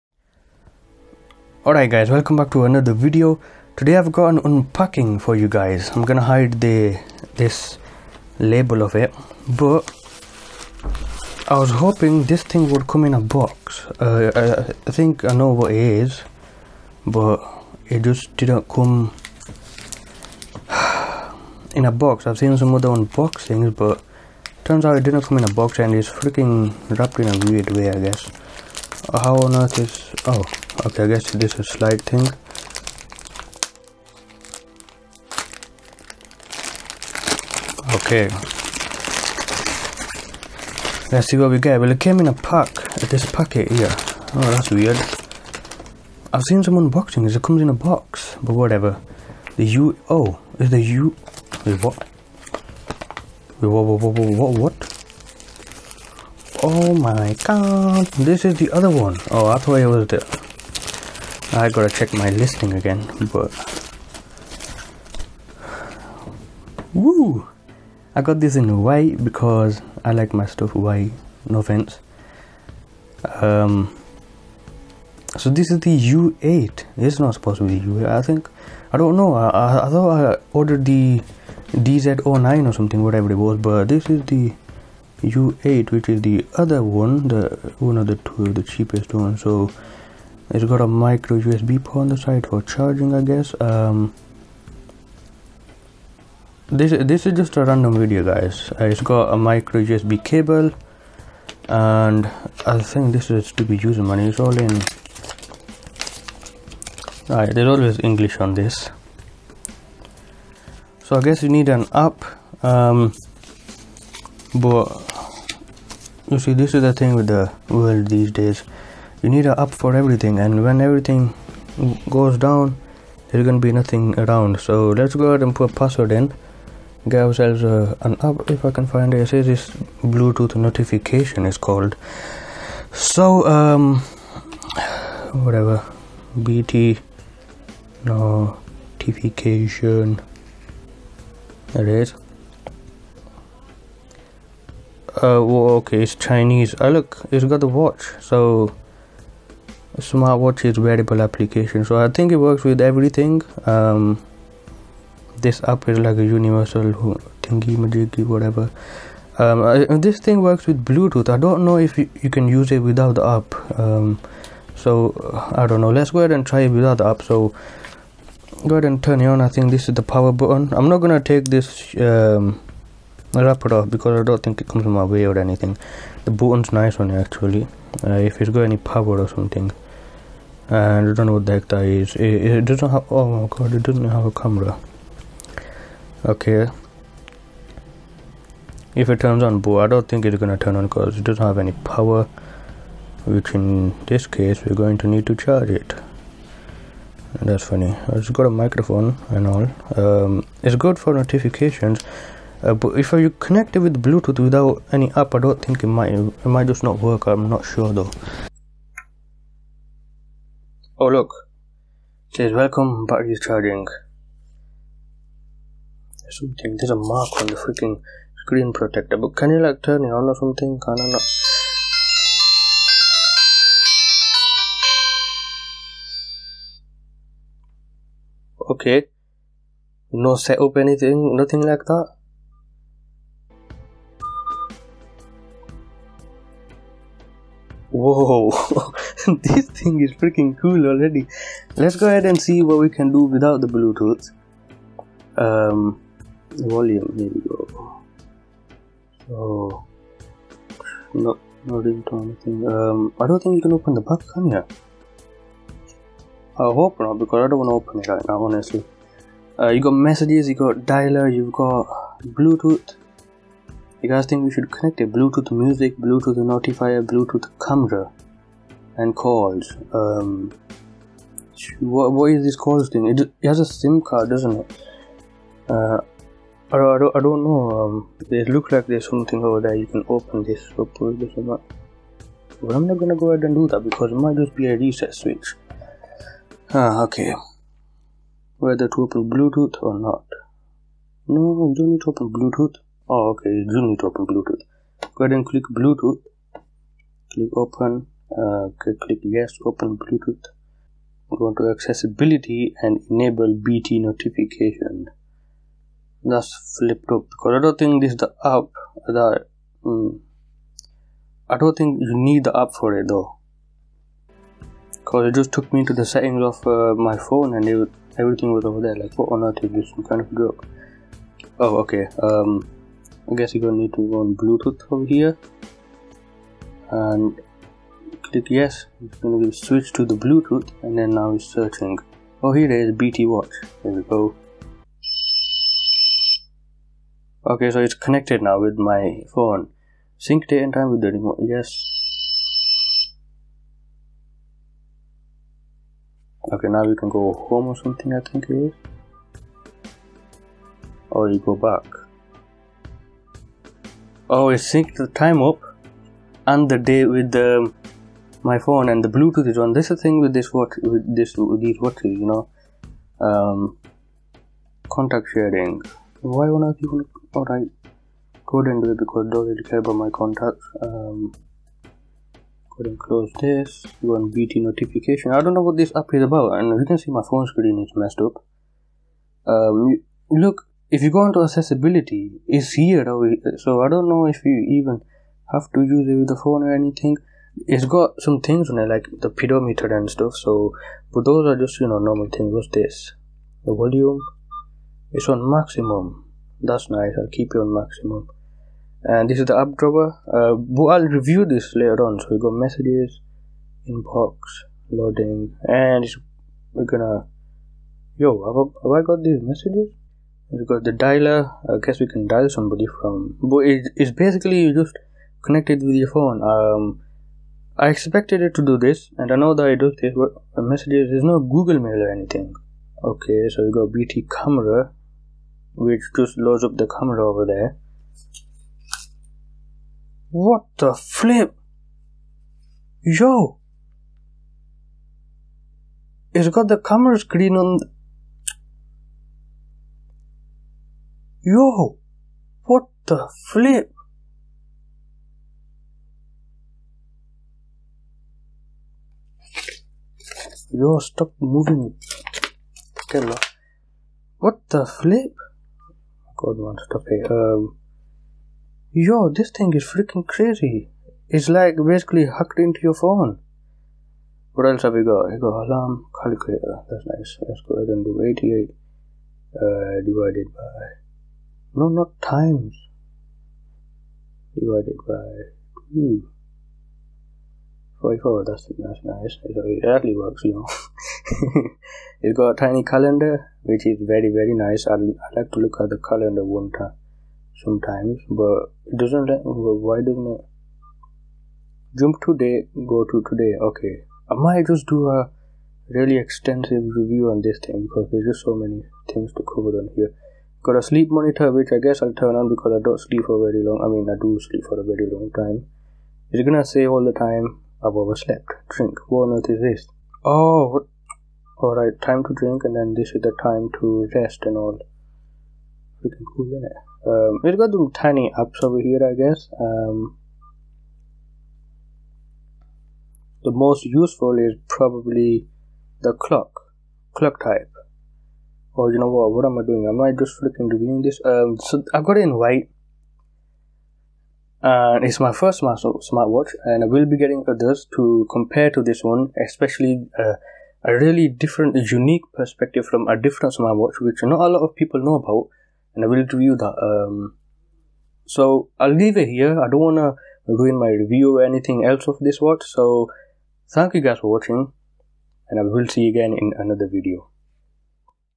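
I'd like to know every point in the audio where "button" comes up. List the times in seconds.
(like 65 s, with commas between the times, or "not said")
170 s, 176 s.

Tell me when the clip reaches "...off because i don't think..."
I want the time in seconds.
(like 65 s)
173 s.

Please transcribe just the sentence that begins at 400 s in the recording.
Uh, but I'll review this later on.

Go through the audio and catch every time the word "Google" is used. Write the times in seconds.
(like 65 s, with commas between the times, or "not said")
421 s.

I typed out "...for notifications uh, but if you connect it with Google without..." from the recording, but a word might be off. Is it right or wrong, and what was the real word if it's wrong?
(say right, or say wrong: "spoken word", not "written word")
wrong: "Bluetooth", not "Google".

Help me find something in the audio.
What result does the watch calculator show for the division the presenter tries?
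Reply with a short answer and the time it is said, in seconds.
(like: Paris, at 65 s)
44, at 478 s.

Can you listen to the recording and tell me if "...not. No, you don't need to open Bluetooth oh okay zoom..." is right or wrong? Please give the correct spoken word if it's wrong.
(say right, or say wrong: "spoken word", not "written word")
right.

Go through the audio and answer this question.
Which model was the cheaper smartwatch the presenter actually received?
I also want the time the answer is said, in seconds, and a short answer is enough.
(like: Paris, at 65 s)
U8, at 84 s.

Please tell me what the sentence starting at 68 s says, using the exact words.
I got this in white because I like my stuff white.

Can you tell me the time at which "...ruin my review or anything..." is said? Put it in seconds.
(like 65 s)
550 s.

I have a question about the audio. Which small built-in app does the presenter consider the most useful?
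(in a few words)
the clock.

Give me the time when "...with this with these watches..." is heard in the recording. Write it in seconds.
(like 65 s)
360 s.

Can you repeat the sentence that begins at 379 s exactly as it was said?
Um, look, if you go into accessibility, it's here.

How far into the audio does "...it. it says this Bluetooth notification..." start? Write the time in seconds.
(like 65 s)
129 s.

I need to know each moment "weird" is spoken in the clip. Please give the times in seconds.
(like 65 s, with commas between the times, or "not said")
27 s, 44 s.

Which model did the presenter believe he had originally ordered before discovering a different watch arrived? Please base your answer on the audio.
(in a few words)
DZ09.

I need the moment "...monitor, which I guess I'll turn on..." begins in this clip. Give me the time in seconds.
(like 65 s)
501 s.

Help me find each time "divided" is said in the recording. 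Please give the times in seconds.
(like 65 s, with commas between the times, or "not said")
470 s, 474 s.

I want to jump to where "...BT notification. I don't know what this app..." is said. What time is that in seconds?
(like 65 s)
374 s.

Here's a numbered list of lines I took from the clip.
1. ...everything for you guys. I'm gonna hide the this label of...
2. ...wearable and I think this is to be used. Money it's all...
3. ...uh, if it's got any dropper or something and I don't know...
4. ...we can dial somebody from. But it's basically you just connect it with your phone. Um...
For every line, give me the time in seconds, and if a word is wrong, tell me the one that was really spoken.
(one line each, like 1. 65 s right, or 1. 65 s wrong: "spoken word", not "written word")
1. 4 s wrong: "unpacking", not "everything"
2. 100 s wrong: "cable", not "wearable"
3. 178 s wrong: "power", not "dropper"
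4. 412 s right.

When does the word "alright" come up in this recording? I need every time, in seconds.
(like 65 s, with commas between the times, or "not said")
1 s, 107 s, 367 s.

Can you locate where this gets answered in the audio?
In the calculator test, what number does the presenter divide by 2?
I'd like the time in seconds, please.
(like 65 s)
468 s.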